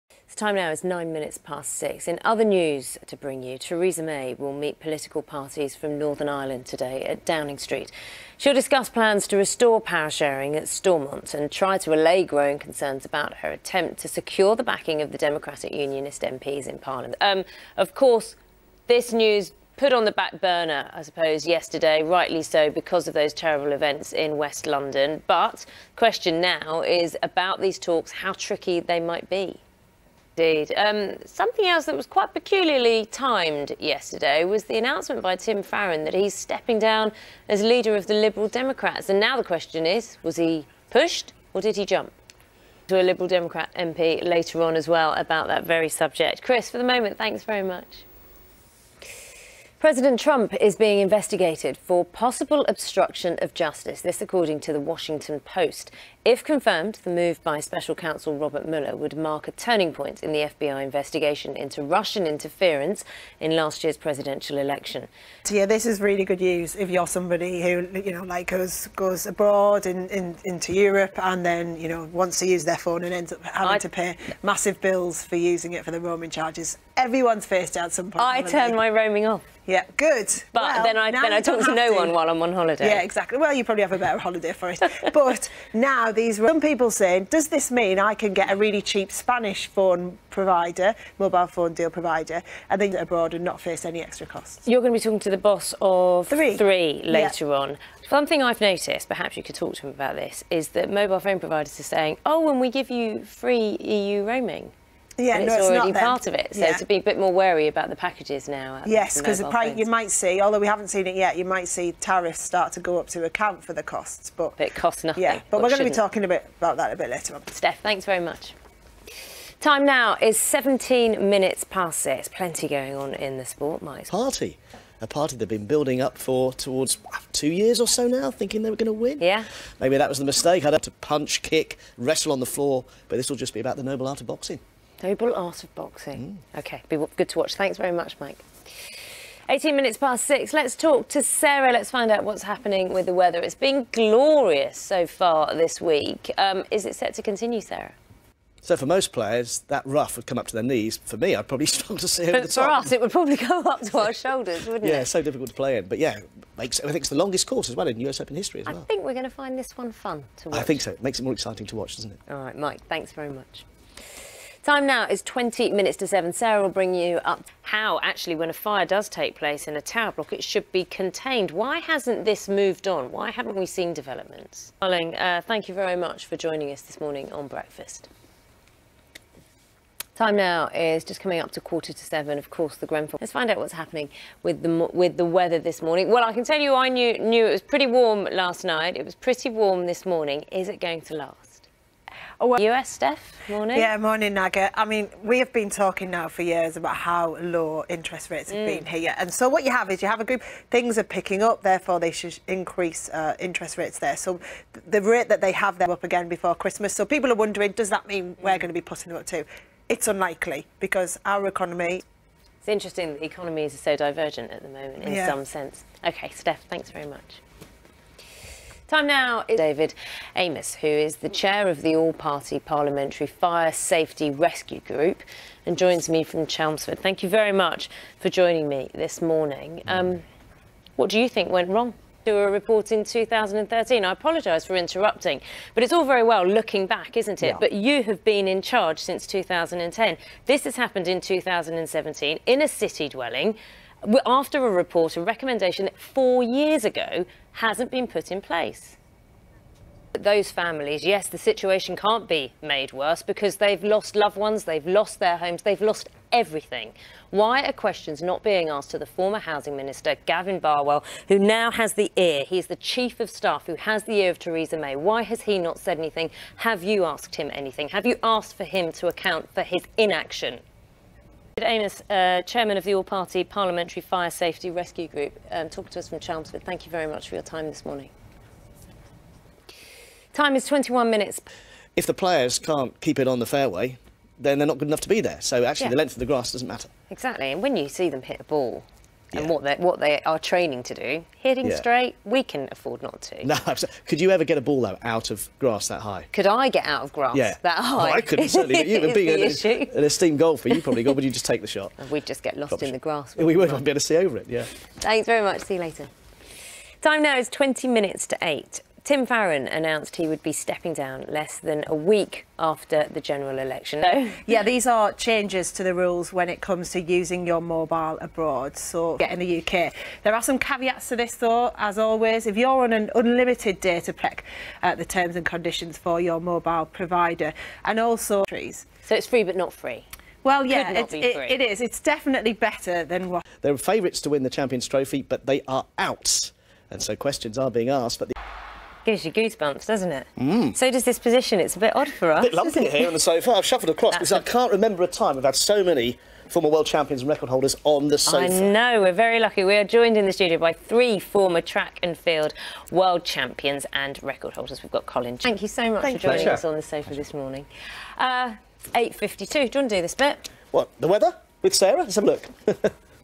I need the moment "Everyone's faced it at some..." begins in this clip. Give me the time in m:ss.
1:16.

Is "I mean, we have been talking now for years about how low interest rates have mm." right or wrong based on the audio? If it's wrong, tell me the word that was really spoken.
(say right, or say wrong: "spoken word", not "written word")
right.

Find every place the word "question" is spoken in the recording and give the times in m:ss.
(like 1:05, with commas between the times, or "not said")
0:25, 0:39, 4:17, 5:37.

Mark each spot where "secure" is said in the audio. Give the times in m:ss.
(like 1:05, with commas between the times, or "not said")
0:14.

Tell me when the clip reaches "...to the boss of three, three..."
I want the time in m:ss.
1:35.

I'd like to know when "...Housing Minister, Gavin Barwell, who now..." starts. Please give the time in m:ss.
4:19.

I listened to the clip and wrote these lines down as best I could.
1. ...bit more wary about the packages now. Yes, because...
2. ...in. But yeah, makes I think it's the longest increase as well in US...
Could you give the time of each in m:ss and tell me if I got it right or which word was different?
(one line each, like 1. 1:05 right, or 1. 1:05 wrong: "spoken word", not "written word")
1. 1:47 right
2. 2:35 wrong: "course", not "increase".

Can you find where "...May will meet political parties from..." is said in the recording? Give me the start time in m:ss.
0:04.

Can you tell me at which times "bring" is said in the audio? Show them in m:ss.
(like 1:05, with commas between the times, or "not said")
0:03, 2:46.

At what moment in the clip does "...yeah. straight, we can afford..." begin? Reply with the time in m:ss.
4:51.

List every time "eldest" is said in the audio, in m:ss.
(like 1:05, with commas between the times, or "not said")
not said.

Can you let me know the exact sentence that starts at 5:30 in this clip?
Well, yeah, it, it, it is.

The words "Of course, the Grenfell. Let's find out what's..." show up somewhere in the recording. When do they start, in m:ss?
3:02.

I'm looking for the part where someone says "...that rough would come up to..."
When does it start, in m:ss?
2:29.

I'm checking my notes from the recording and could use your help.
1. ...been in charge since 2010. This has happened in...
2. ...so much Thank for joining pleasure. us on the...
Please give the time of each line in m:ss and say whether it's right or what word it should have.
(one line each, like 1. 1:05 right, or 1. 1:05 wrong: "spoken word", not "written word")
1. 3:58 right
2. 5:55 right.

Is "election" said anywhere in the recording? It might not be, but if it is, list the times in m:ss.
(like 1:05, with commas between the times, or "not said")
1:04, 5:13.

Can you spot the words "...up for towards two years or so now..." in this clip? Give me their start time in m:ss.
2:05.